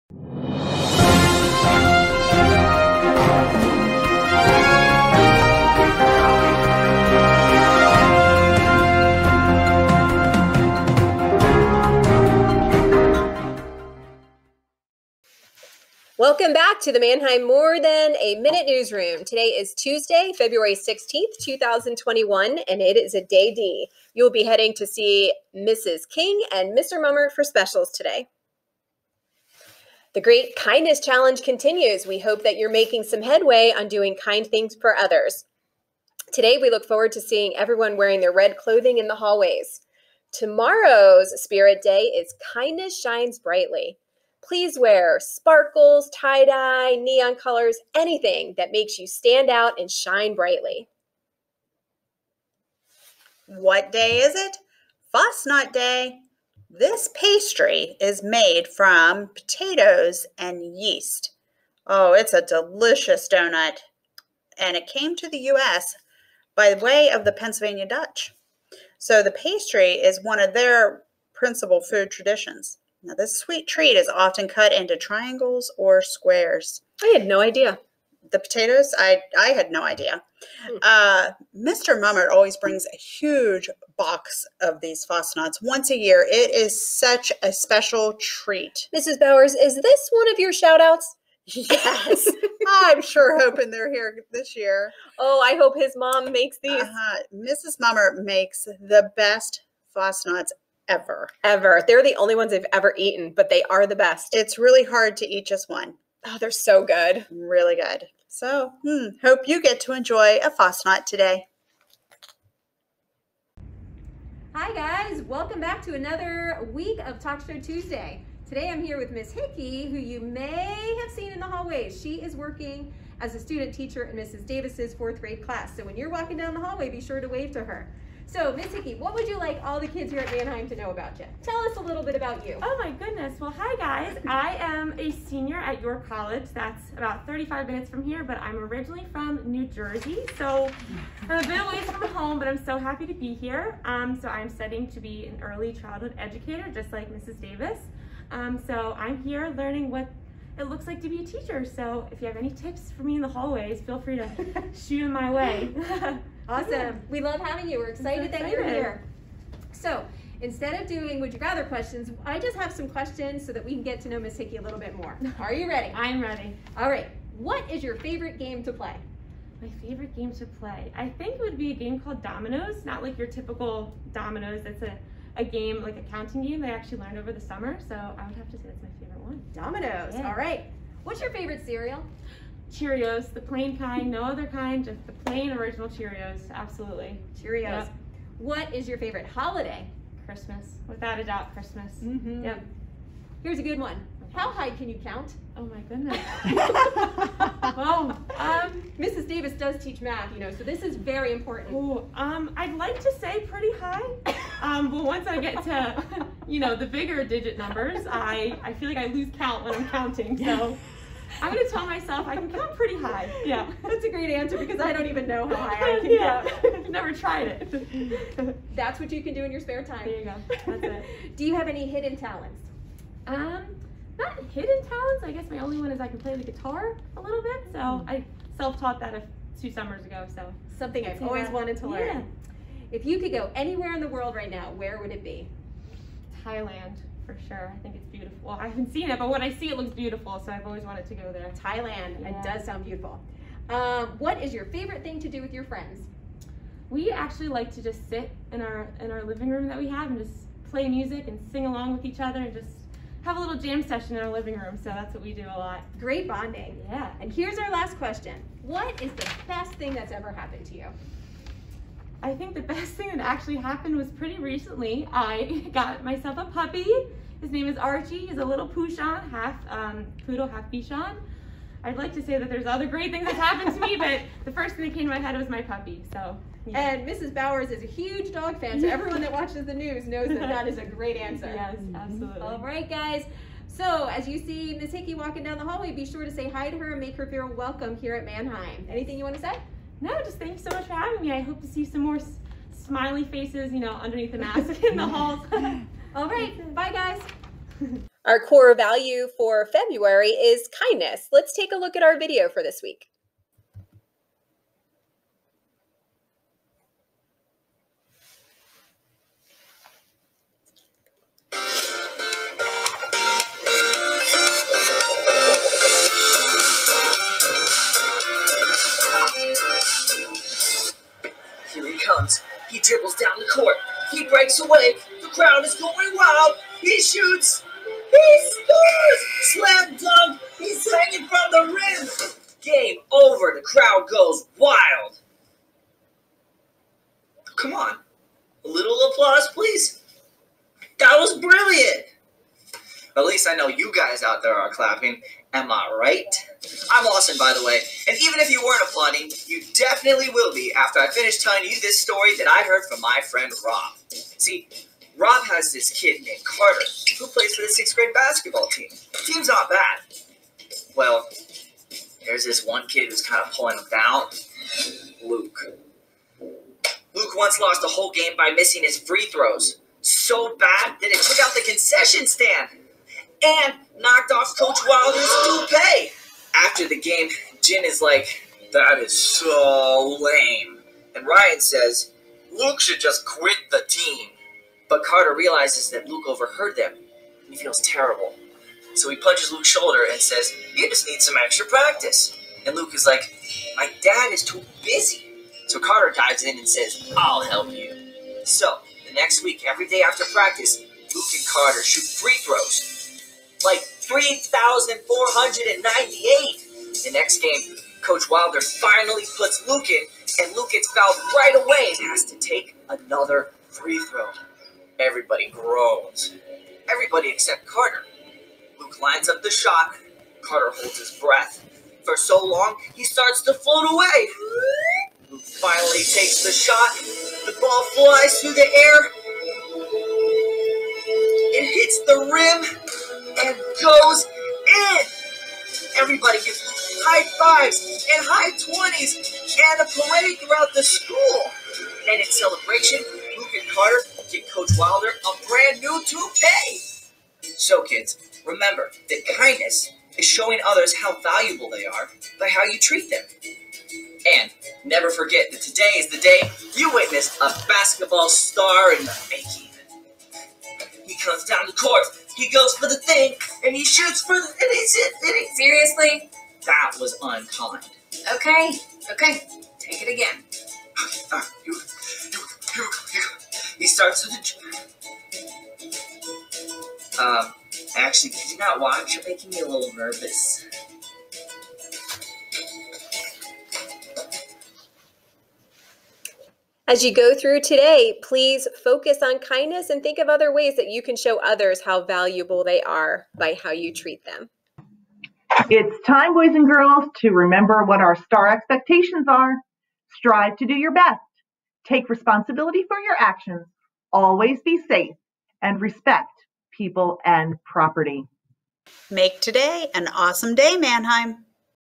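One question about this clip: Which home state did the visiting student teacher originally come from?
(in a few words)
New Jersey.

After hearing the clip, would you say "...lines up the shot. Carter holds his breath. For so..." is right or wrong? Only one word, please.
right.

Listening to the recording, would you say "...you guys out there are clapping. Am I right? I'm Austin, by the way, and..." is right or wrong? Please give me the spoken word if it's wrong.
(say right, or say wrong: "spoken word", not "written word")
right.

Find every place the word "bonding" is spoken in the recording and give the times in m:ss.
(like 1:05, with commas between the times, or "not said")
4:16.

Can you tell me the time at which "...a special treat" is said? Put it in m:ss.
1:27.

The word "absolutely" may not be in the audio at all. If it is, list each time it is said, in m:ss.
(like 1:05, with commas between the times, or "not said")
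3:06, 4:41.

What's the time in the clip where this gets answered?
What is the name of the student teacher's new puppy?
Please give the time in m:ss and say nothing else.
4:27.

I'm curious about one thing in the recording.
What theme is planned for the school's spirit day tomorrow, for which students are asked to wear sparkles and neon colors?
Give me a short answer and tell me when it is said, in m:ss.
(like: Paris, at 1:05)
Kindness Shines Brightly, at 0:42.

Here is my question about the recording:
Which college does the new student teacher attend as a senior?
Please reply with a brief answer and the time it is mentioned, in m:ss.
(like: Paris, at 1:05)
York College, at 2:15.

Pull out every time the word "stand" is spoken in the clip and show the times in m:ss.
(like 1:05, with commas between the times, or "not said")
0:49, 6:12.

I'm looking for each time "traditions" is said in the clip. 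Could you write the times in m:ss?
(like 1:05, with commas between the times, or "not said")
1:12.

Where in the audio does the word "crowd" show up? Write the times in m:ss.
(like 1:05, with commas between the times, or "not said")
5:25, 5:33.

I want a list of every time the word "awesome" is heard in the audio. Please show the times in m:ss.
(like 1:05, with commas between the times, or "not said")
2:36, 8:30.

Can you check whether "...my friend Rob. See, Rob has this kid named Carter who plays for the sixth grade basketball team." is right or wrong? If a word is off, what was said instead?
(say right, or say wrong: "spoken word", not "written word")
right.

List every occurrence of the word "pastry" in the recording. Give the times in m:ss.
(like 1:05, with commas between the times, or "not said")
0:57, 1:09.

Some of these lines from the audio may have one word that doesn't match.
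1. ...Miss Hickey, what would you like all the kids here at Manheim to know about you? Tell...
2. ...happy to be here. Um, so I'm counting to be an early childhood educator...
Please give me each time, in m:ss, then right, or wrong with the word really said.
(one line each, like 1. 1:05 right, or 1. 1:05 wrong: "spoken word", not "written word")
1. 2:08 right
2. 2:22 wrong: "studying", not "counting".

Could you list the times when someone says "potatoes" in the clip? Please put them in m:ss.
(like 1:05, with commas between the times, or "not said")
0:59, 1:18.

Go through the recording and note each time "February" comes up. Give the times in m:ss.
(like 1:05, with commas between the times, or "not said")
0:20, 4:59.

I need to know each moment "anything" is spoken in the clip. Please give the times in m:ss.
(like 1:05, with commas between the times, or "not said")
0:47, 4:48.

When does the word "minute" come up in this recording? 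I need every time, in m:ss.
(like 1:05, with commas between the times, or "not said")
0:18, 2:17.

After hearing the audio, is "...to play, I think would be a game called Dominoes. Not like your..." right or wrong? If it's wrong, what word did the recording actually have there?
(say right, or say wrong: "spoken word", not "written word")
right.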